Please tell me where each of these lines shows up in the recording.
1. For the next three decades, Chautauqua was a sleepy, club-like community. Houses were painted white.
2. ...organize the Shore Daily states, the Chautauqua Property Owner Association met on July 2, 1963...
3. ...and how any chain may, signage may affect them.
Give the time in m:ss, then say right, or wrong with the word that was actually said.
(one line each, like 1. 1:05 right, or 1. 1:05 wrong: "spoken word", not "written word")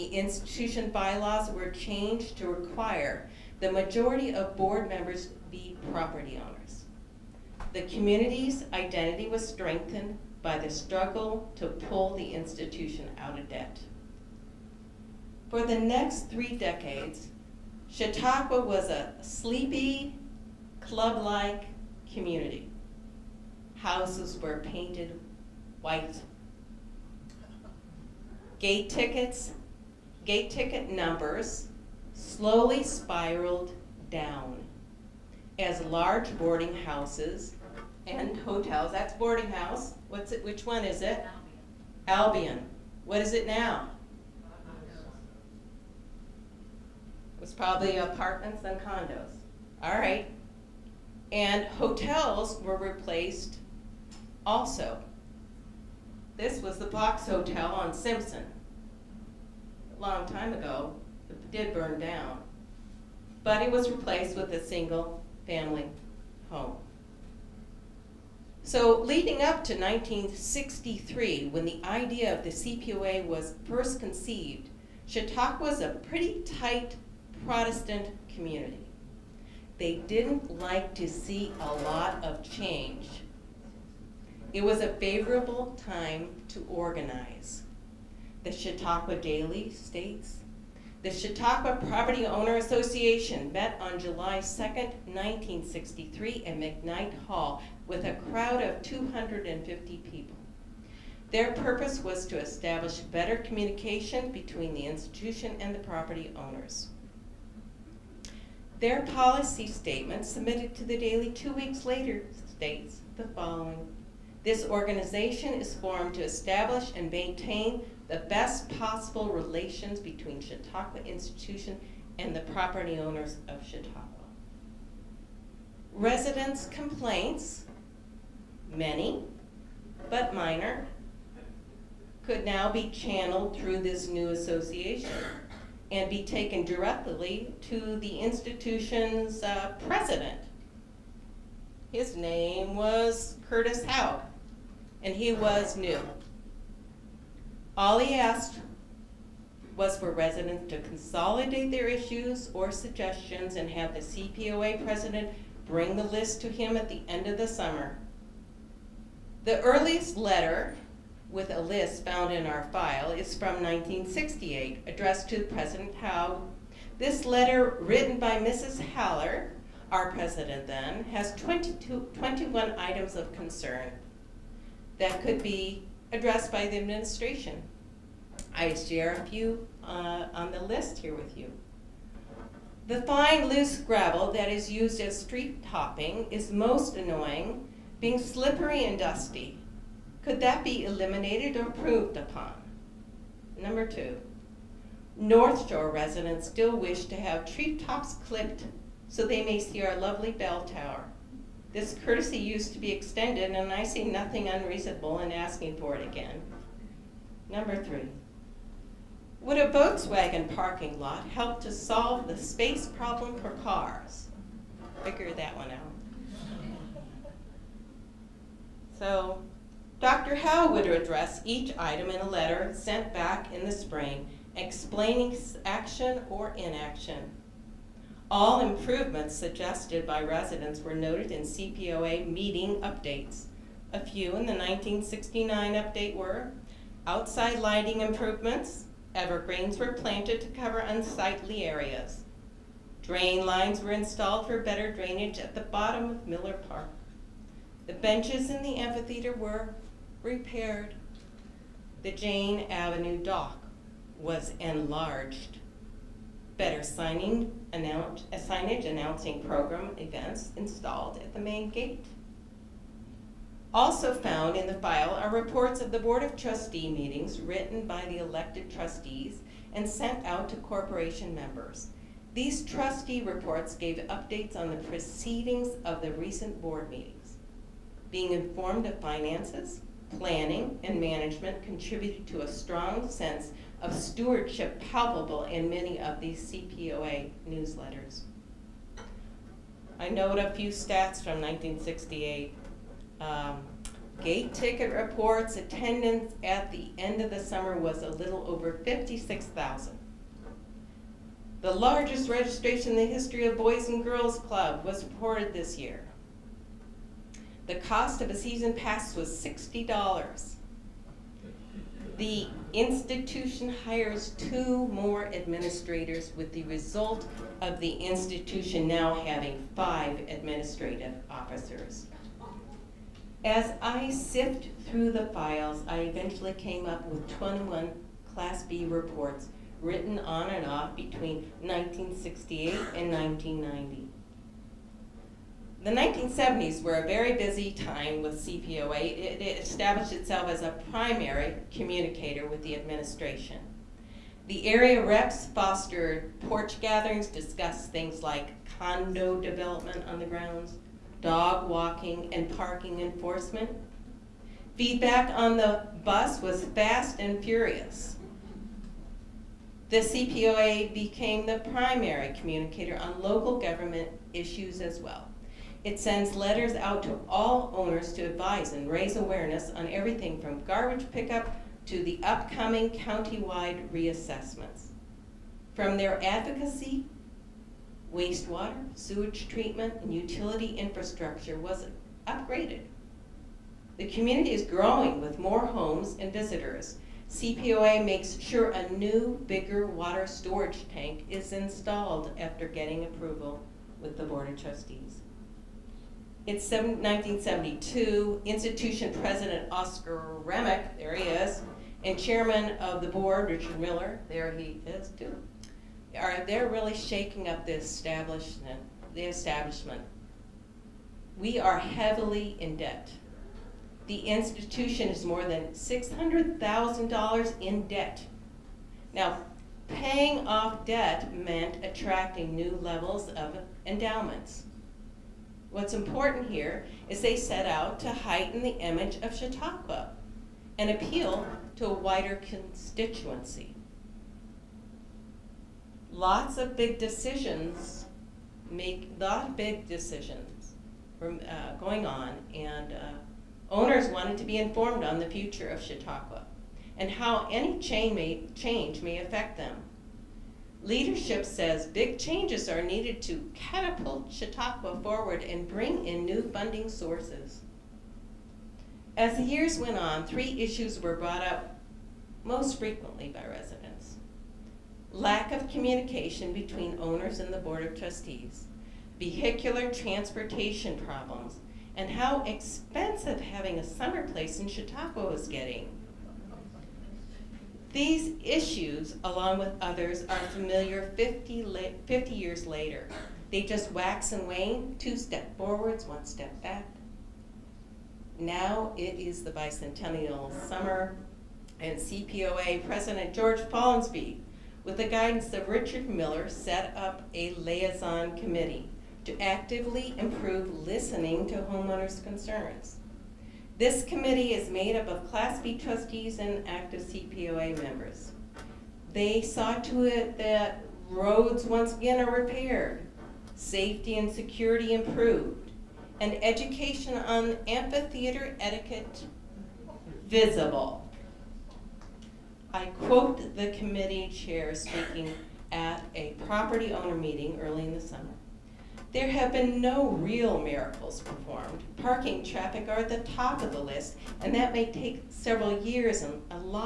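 1. 0:15 right
2. 1:26 wrong: "Chautauqua", not "Shore"
3. 7:26 wrong: "change", not "signage".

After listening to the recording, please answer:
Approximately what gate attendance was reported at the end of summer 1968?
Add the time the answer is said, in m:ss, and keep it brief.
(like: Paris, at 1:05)
56,000, at 4:58.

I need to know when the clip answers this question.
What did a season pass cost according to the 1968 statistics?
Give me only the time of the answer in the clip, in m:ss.
5:09.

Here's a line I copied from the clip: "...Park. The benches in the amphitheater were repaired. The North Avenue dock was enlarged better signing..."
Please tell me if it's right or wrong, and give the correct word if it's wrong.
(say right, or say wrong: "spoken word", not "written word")
wrong: "Jane", not "North".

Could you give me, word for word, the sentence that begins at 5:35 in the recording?
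The 1970s were a very busy time with CPOA.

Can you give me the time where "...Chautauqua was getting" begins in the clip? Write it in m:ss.
7:54.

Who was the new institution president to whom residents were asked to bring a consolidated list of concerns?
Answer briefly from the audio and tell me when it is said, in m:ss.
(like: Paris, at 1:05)
Curtis Howe, at 2:23.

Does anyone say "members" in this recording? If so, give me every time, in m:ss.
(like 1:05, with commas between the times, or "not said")
0:04, 4:31, 8:27.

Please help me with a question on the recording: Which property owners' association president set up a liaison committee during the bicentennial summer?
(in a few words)
George Polensby.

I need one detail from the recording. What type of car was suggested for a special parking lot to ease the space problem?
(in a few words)
Volkswagen.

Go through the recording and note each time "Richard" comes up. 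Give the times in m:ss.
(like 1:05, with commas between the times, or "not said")
6:43, 8:15.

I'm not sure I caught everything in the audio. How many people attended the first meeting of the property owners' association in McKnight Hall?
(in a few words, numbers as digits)
250.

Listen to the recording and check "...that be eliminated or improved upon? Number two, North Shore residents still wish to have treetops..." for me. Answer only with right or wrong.
right.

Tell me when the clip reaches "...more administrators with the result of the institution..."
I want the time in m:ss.
5:14.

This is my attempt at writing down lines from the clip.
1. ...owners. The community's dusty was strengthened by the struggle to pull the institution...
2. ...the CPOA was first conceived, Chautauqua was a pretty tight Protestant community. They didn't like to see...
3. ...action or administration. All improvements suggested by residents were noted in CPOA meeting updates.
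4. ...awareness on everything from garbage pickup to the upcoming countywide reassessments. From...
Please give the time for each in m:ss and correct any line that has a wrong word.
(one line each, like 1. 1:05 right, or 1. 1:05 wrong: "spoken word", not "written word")
1. 0:06 wrong: "identity", not "dusty"
2. 1:12 right
3. 3:45 wrong: "inaction", not "administration"
4. 6:09 right.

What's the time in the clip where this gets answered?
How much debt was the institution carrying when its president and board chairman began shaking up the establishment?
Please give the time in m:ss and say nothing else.
6:55.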